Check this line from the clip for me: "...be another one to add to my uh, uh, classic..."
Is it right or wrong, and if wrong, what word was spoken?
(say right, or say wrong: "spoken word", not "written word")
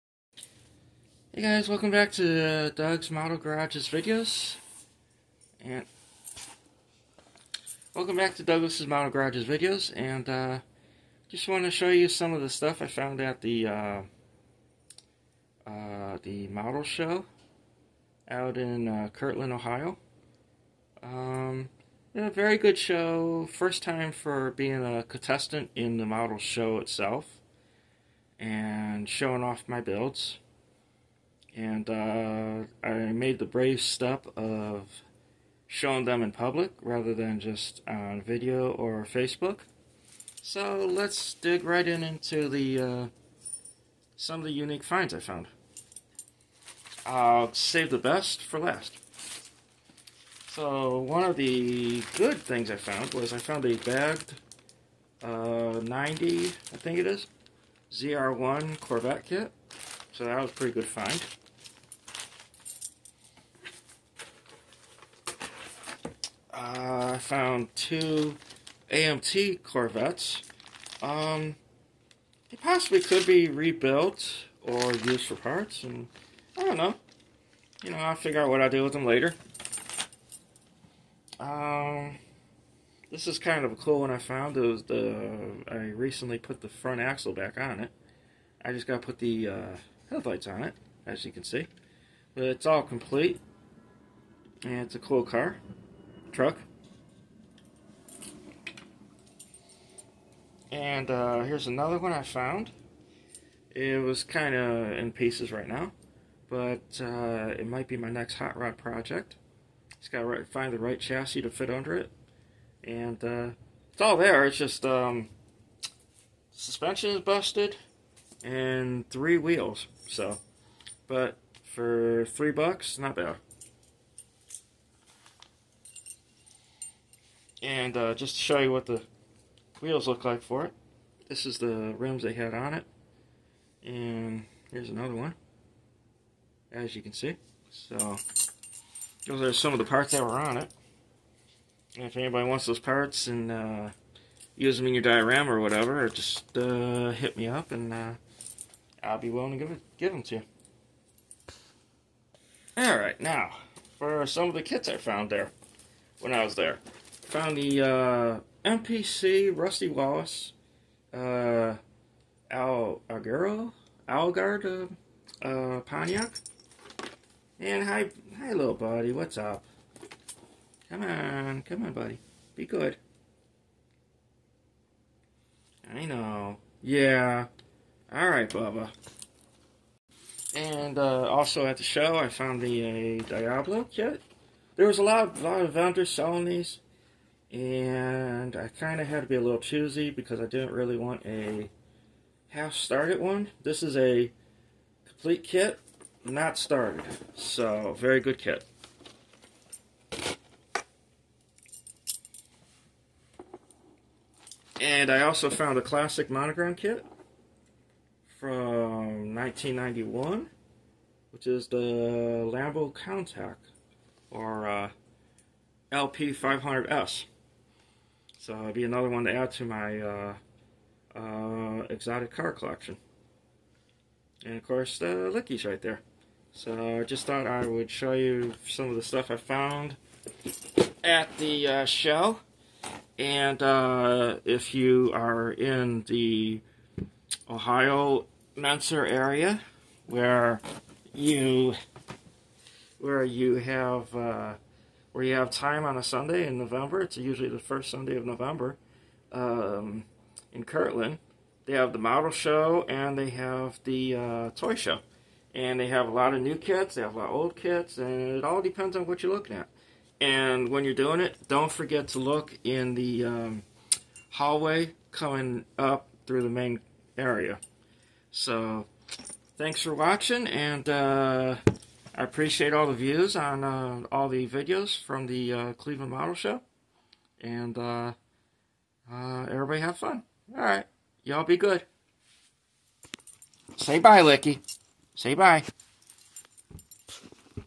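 wrong: "exotic", not "classic".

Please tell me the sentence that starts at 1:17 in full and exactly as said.
You know, I'll figure out what I do with them later.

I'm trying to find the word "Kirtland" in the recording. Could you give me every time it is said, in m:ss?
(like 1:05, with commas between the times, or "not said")
0:19, 4:10.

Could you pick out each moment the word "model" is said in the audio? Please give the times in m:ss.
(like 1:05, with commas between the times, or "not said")
0:03, 0:08, 0:16, 0:26, 4:11, 4:36.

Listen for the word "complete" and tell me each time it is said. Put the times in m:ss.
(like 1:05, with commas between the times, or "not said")
1:32, 3:15.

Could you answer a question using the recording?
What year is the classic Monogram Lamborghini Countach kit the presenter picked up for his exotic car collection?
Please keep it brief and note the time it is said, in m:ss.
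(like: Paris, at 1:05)
1991, at 3:29.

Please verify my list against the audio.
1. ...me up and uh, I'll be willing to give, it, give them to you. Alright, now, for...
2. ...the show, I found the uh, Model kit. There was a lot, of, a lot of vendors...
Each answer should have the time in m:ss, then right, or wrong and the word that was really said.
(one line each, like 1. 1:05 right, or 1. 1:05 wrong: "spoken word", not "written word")
1. 2:27 right
2. 3:01 wrong: "Diablo", not "Model".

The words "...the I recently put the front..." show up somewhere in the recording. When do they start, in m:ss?
1:24.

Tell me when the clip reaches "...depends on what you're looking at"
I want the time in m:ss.
4:18.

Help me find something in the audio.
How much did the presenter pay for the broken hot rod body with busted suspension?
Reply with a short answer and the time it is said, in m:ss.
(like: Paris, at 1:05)
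$3, at 2:02.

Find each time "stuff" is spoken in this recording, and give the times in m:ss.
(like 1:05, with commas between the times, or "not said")
0:12, 3:49.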